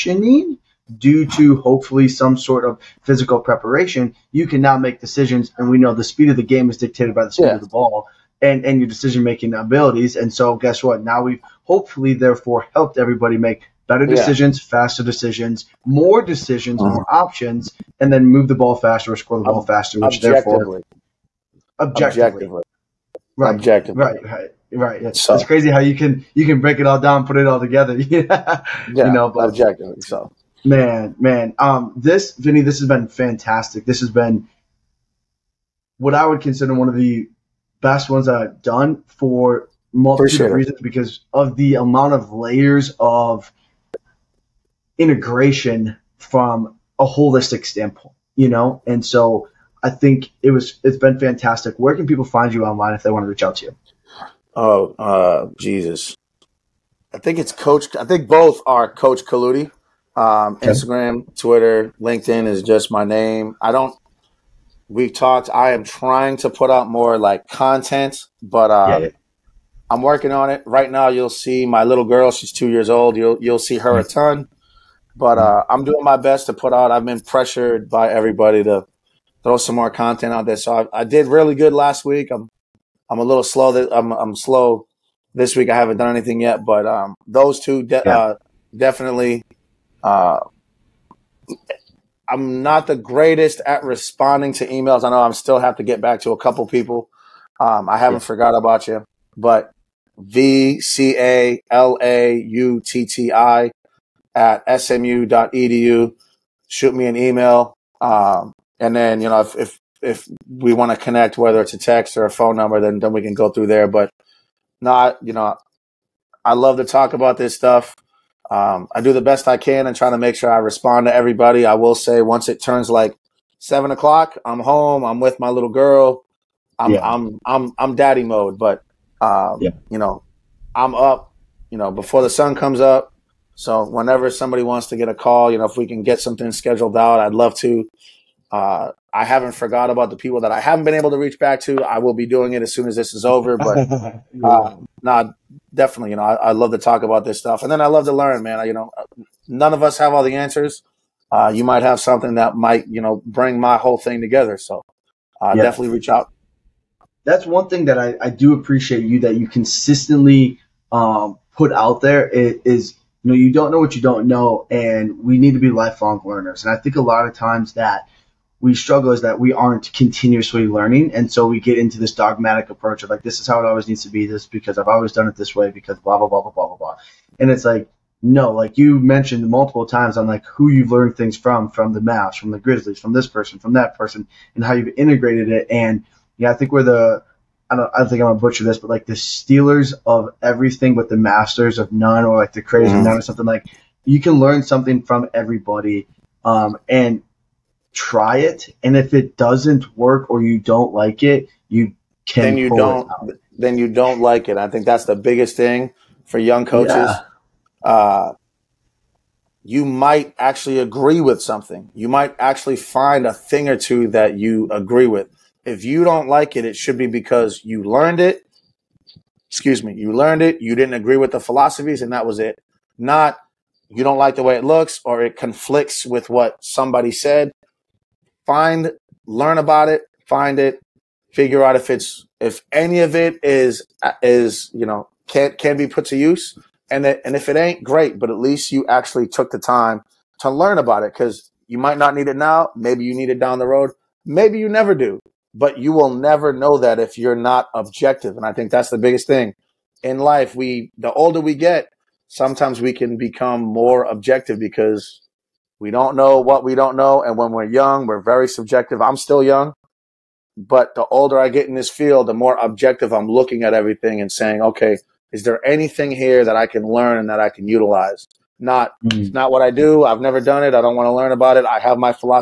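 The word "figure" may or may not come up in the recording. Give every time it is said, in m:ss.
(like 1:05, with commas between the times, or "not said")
3:51.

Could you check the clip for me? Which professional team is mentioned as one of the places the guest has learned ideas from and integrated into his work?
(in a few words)
The Grizzlies.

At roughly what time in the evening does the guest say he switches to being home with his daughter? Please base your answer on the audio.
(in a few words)
7 o'clock.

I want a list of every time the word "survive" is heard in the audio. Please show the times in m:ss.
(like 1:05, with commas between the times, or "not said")
not said.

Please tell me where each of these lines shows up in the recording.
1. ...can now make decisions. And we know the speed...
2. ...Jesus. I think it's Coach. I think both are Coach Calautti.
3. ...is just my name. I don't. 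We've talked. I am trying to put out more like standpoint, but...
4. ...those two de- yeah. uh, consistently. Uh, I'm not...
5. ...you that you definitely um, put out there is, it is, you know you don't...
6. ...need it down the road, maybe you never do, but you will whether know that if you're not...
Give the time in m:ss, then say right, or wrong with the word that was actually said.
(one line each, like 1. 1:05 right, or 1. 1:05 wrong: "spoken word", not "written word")
1. 0:04 right
2. 0:55 right
3. 1:02 wrong: "content", not "standpoint"
4. 1:27 wrong: "definitely", not "consistently"
5. 2:39 wrong: "consistently", not "definitely"
6. 4:03 wrong: "never", not "whether".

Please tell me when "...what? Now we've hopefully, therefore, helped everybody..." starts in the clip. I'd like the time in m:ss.
0:10.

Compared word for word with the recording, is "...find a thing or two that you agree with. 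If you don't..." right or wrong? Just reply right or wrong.
right.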